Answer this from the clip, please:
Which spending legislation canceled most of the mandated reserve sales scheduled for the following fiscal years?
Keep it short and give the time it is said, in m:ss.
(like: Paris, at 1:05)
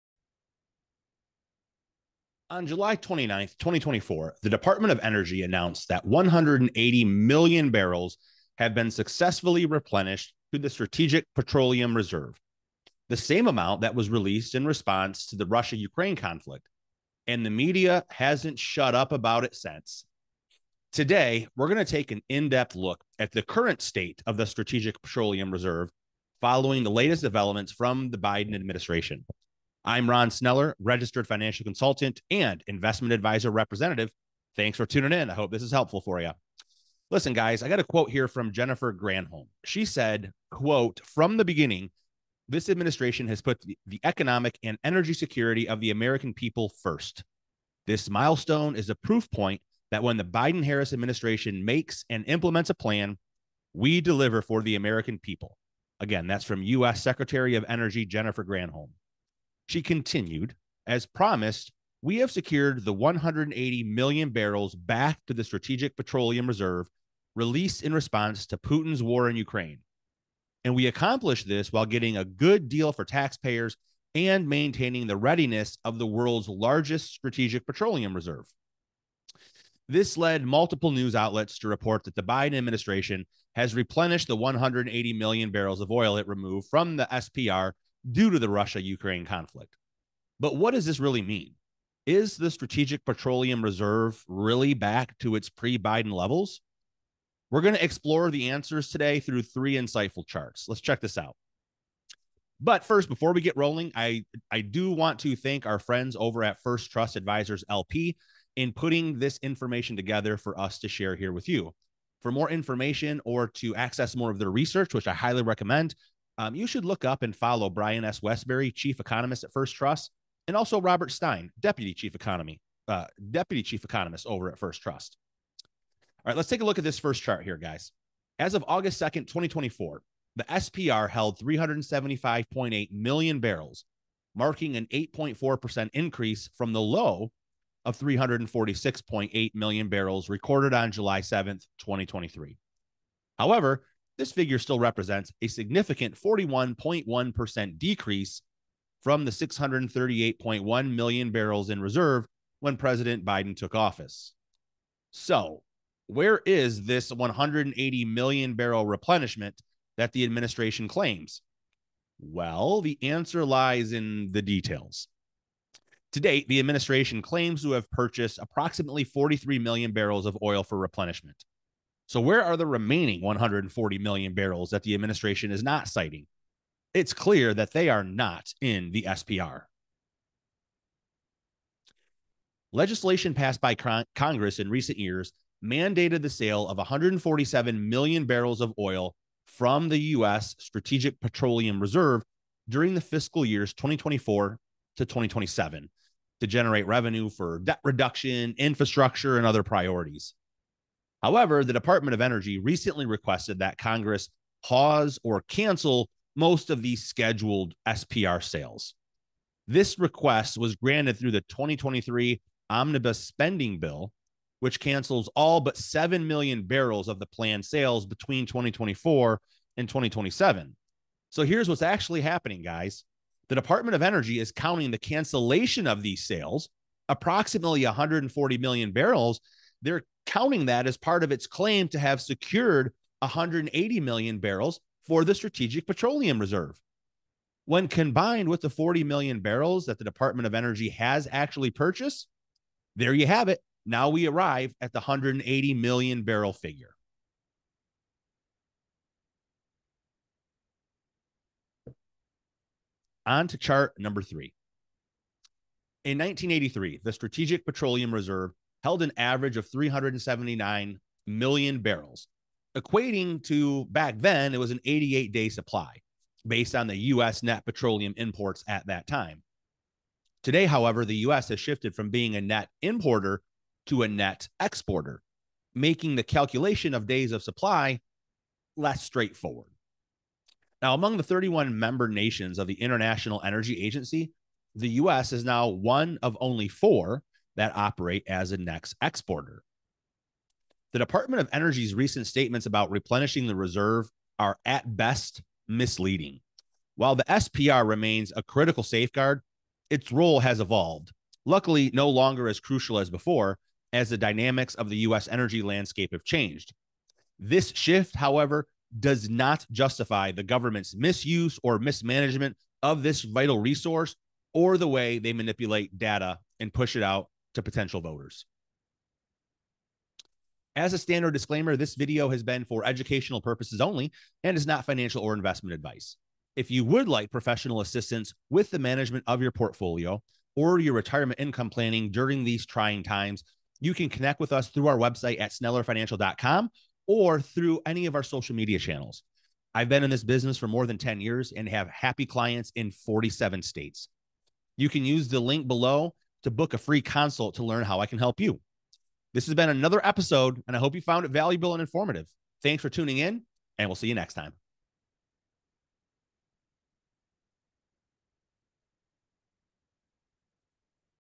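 2023 omnibus spending bill, at 3:31.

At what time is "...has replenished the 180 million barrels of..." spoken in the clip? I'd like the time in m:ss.
1:23.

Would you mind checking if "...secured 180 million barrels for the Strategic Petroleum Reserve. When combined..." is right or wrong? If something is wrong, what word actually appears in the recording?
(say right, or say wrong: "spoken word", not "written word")
right.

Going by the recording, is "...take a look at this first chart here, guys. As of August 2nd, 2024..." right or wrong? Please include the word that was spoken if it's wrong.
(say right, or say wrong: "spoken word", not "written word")
right.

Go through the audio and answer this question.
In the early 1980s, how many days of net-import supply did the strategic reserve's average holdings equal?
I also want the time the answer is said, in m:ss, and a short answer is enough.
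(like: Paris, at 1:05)
88 days, at 4:24.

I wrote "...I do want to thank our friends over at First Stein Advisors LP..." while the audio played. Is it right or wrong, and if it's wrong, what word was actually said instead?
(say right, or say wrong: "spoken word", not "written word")
wrong: "Trust", not "Stein".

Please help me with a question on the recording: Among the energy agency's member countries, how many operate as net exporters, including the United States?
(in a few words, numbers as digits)
4.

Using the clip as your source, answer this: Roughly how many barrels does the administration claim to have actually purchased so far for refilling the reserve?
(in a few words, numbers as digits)
43 million barrels.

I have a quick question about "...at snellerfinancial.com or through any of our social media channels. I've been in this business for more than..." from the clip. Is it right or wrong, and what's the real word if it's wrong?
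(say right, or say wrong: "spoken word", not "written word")
right.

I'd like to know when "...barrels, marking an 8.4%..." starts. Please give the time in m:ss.
2:13.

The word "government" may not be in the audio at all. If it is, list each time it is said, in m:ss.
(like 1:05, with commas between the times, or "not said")
5:10.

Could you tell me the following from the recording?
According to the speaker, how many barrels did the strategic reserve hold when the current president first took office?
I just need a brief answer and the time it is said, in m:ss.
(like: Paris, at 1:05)
638.1 million barrels, at 2:29.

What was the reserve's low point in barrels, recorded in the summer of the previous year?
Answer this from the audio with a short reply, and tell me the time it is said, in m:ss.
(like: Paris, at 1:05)
346.8 million barrels, at 2:17.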